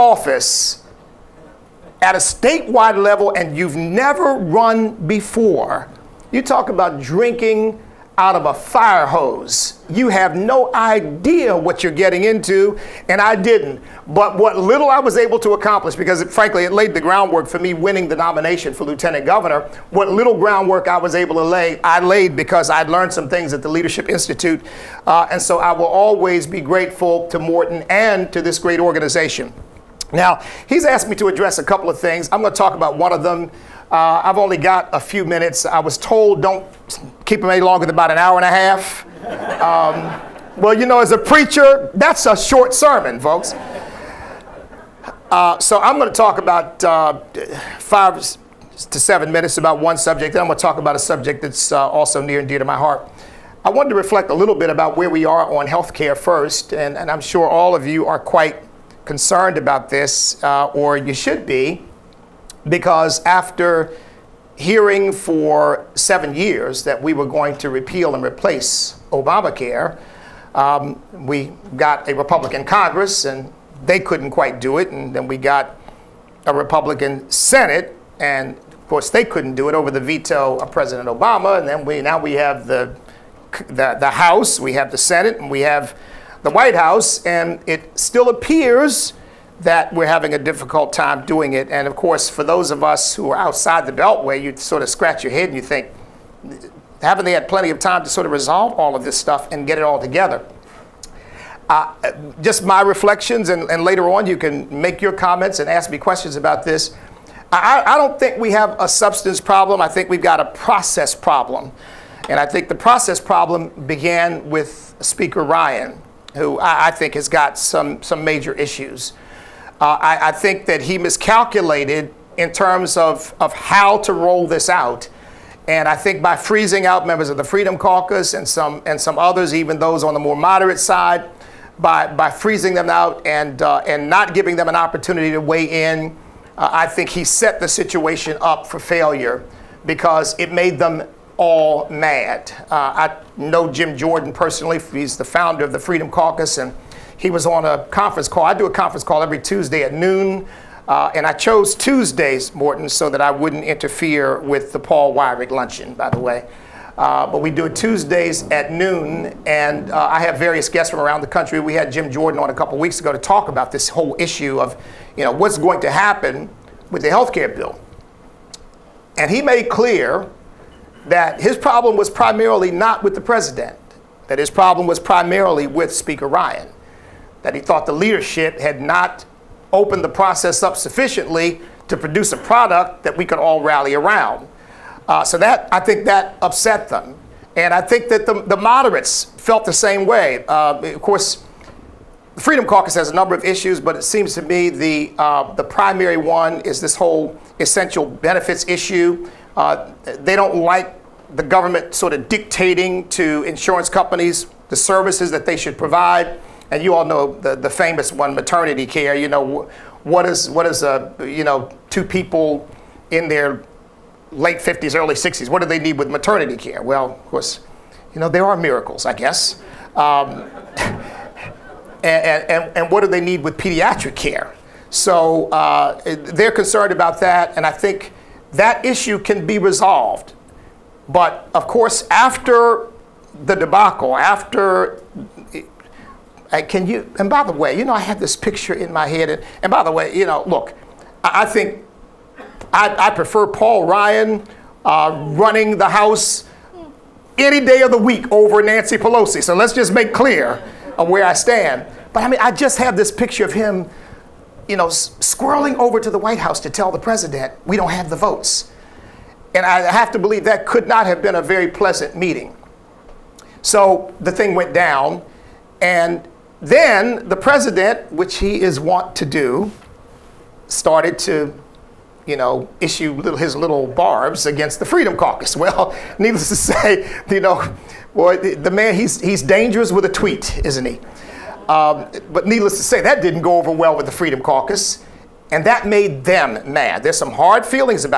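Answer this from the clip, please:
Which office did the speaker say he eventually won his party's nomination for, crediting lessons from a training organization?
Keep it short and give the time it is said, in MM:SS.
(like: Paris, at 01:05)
Lieutenant governor, at 00:18.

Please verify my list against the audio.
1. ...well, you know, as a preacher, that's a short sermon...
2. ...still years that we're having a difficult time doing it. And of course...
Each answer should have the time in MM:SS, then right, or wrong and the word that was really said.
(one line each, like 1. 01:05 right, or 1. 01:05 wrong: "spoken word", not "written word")
1. 00:40 right
2. 01:27 wrong: "appears", not "years".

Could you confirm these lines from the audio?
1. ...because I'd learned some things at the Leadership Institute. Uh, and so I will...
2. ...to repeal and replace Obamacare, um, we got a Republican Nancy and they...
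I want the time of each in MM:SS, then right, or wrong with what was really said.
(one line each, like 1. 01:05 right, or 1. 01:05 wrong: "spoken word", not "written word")
1. 00:22 right
2. 01:07 wrong: "Congress", not "Nancy".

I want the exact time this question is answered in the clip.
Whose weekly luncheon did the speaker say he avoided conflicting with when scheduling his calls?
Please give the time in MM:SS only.
02:34.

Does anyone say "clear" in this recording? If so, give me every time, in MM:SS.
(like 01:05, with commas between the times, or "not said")
02:49, 04:10.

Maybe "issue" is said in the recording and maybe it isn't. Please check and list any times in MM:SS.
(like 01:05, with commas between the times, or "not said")
01:58, 02:44, 03:13, 03:18, 03:48, 04:32.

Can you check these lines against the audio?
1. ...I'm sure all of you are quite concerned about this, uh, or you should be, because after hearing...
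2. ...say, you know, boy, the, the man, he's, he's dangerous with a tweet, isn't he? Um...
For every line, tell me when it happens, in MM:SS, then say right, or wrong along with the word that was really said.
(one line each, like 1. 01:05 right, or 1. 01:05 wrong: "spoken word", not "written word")
1. 00:57 right
2. 04:36 right.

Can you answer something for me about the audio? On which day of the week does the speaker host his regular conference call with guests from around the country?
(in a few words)
Tuesday.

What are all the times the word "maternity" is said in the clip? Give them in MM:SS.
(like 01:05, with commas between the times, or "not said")
03:28, 03:36.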